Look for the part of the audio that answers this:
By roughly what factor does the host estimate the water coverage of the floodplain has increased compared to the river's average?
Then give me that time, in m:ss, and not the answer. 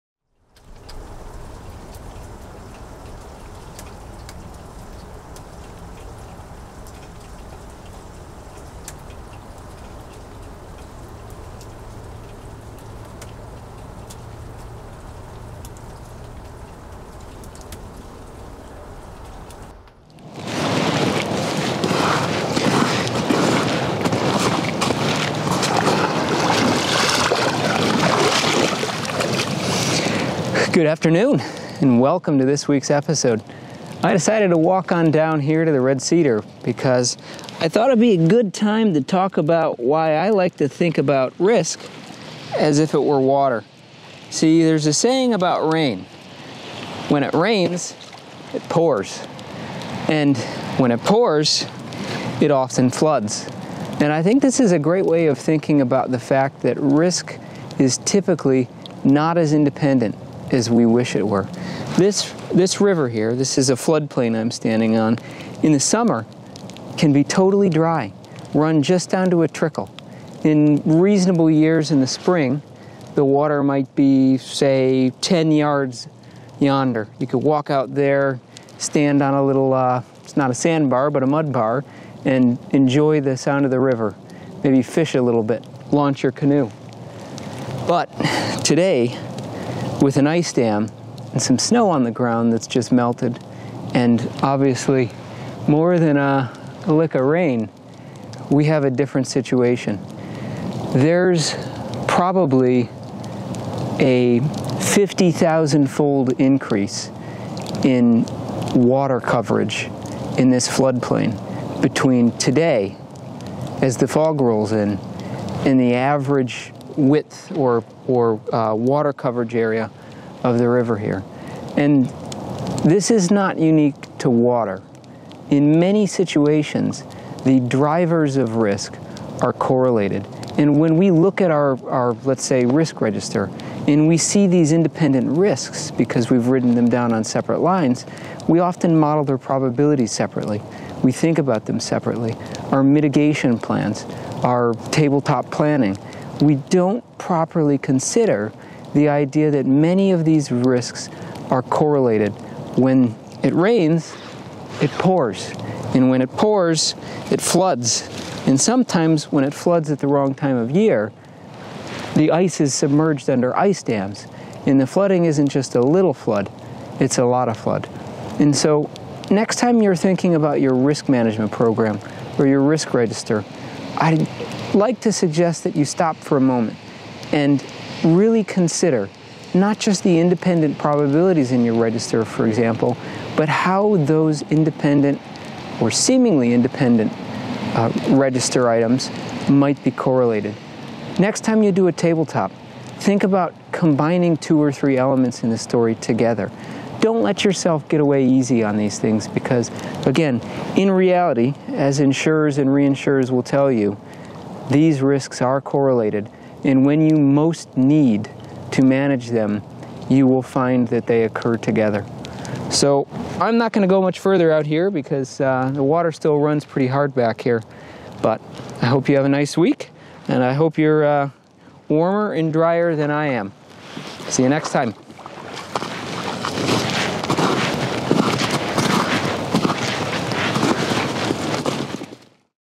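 1:44.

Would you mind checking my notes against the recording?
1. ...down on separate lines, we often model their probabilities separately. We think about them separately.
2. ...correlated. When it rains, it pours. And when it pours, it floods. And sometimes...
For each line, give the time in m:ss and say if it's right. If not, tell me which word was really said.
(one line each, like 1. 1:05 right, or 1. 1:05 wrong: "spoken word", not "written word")
1. 2:16 right
2. 2:31 right.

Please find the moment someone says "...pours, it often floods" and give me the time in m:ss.
0:51.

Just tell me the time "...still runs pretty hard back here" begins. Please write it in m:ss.
3:36.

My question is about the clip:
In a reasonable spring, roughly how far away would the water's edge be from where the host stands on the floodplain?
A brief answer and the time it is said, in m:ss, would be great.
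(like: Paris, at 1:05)
10 yards, at 1:15.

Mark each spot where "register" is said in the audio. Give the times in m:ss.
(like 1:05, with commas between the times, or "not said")
2:13, 2:52, 3:01, 3:08.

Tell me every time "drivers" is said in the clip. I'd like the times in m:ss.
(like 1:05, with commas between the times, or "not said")
2:07.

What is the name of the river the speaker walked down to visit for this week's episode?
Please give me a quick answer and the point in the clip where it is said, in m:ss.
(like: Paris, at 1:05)
Red Cedar, at 0:35.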